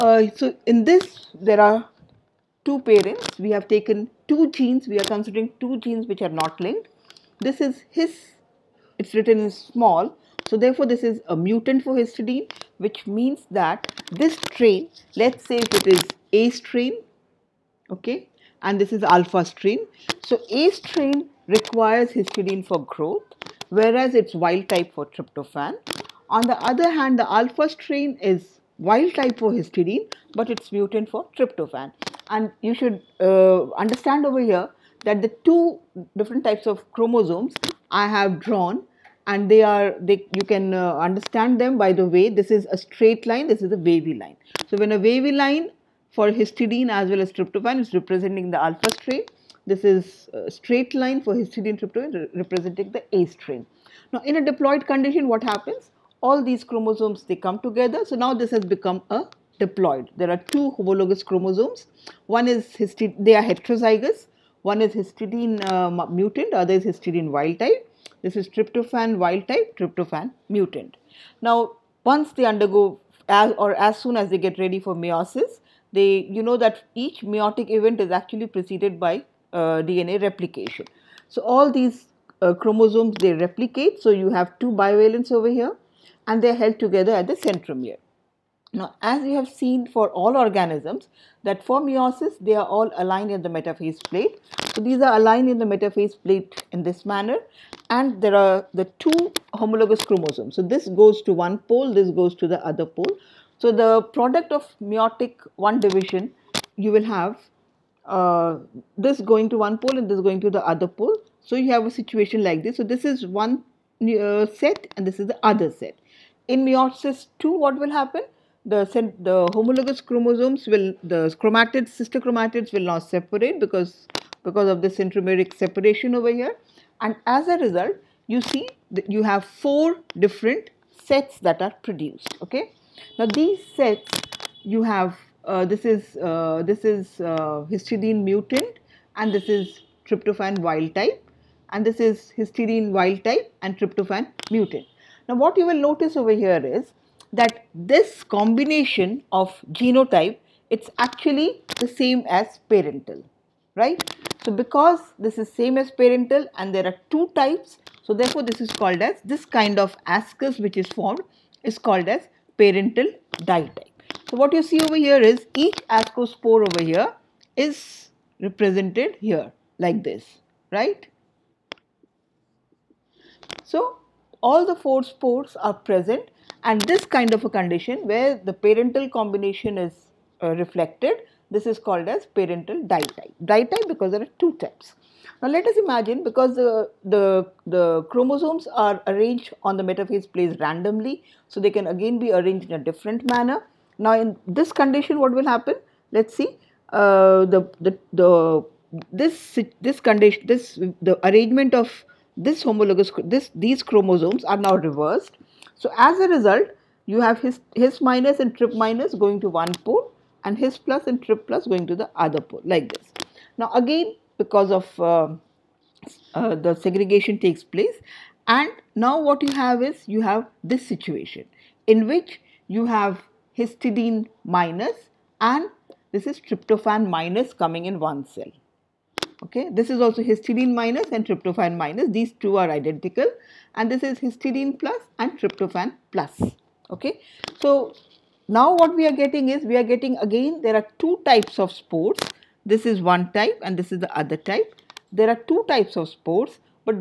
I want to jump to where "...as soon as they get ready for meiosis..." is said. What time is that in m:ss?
1:13.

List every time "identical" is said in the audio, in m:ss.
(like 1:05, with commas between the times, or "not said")
3:52.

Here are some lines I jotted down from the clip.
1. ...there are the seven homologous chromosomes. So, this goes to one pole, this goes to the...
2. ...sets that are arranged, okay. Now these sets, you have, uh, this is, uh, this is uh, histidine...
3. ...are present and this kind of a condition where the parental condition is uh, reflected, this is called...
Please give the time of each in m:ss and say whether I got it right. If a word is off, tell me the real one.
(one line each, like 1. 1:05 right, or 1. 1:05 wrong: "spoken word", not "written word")
1. 1:38 wrong: "two", not "seven"
2. 2:10 wrong: "produced", not "arranged"
3. 2:55 wrong: "combination", not "condition".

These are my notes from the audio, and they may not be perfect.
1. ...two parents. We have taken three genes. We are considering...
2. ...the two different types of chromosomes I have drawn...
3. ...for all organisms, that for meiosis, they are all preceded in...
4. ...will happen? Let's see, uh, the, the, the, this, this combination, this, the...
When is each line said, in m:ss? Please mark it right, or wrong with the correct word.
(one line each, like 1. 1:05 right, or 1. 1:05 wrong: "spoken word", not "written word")
1. 0:02 wrong: "two", not "three"
2. 0:35 right
3. 1:29 wrong: "aligned", not "preceded"
4. 3:15 wrong: "condition", not "combination".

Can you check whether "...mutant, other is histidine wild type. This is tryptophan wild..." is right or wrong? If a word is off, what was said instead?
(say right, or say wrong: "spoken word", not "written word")
right.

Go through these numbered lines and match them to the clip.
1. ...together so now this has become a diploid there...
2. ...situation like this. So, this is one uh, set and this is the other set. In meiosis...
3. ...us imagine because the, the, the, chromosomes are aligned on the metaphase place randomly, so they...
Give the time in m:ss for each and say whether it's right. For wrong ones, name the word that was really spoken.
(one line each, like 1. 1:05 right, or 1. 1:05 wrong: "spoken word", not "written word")
1. 0:57 right
2. 1:51 right
3. 3:05 wrong: "arranged", not "aligned".